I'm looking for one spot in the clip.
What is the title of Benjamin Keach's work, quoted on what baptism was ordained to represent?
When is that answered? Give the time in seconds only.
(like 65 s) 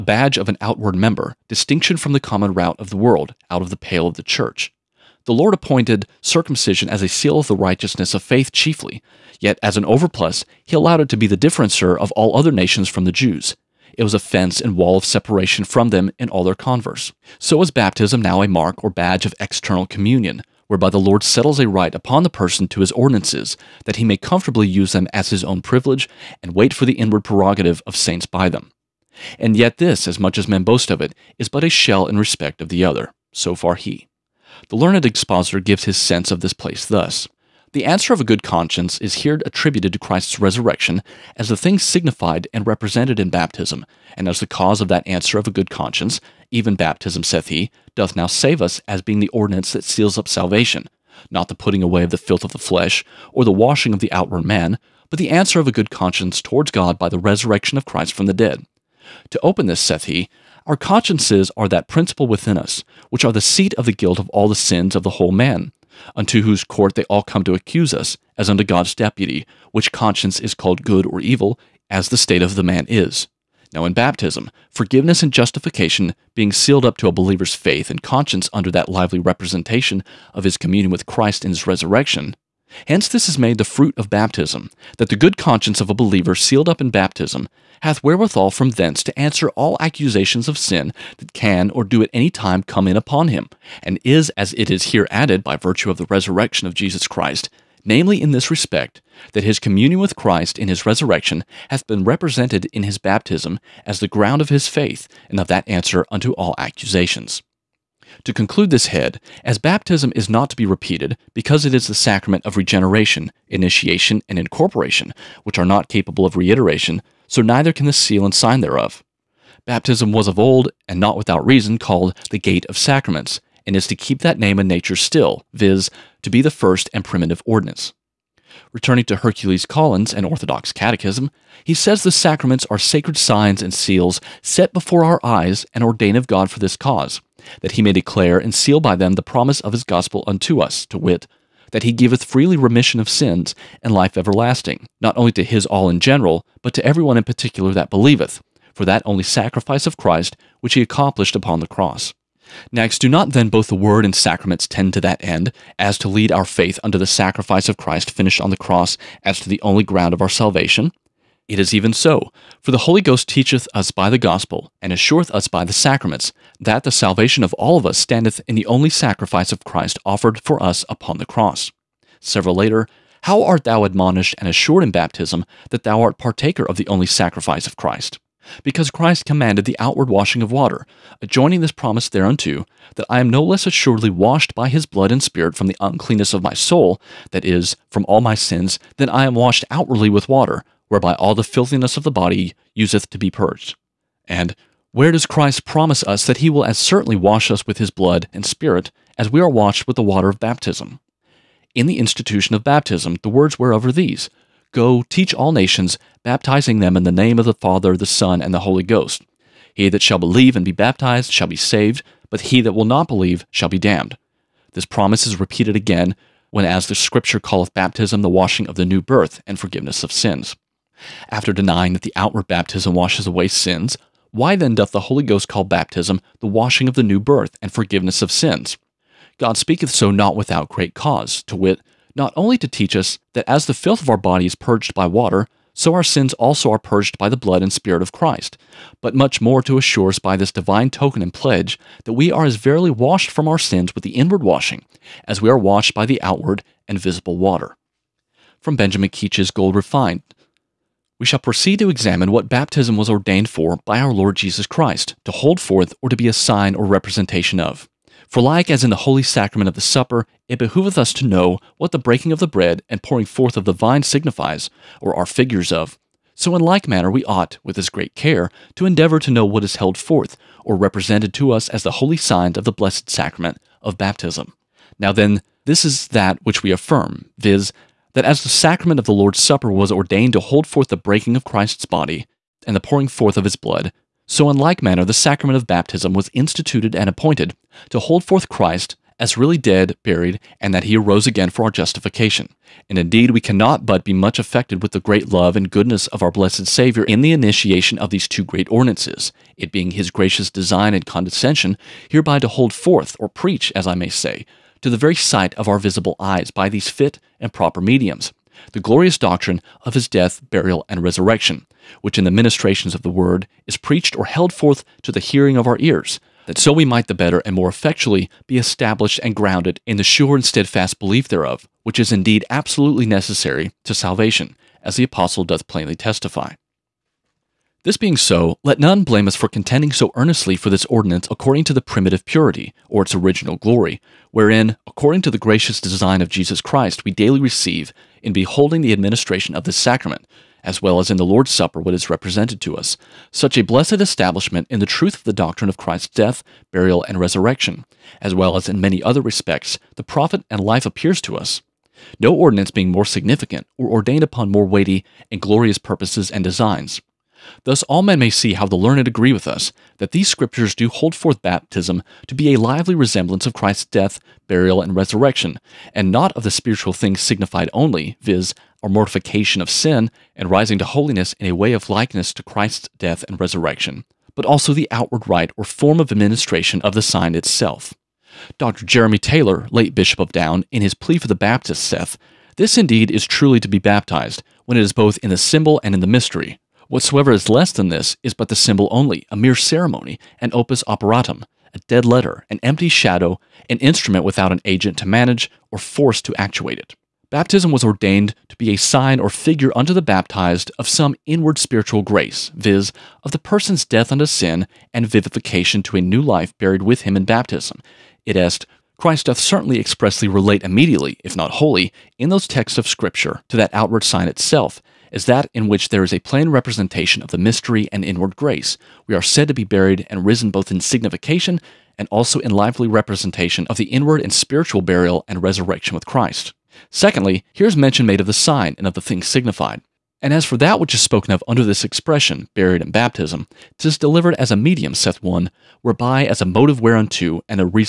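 249 s.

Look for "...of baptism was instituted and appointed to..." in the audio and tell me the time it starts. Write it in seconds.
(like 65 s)
285 s.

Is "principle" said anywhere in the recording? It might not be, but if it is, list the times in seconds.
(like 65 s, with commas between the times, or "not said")
61 s.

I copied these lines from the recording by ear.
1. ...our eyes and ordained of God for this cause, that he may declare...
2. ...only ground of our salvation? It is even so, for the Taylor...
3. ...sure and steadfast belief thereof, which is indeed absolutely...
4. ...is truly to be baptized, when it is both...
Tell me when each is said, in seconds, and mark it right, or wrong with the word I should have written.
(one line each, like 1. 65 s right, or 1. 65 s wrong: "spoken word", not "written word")
1. 135 s right
2. 159 s wrong: "Holy", not "Taylor"
3. 320 s right
4. 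383 s right.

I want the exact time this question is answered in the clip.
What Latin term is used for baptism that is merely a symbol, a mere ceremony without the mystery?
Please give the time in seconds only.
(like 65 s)
390 s.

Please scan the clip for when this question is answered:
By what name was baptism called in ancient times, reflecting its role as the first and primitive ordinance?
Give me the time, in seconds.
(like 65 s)
122 s.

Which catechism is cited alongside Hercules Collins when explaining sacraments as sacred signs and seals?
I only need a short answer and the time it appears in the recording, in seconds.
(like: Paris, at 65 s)
Orthodox Catechism, at 130 s.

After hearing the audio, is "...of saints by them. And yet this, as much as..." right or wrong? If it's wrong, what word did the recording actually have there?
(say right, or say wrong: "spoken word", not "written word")
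right.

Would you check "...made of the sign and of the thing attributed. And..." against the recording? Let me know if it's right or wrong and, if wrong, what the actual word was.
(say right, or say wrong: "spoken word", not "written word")
wrong: "signified", not "attributed".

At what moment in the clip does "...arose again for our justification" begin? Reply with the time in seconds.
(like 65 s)
290 s.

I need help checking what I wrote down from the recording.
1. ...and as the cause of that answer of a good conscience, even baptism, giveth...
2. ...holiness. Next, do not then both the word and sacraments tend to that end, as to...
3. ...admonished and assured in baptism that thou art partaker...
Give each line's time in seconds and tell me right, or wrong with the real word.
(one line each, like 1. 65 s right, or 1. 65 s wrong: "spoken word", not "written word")
1. 44 s wrong: "saith", not "giveth"
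2. 151 s wrong: "cross", not "holiness"
3. 173 s right.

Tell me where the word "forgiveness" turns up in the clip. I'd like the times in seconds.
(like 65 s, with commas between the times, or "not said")
74 s, 219 s, 227 s.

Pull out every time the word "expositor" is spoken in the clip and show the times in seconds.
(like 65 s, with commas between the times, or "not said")
35 s.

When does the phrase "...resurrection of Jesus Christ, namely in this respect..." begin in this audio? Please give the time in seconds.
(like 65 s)
96 s.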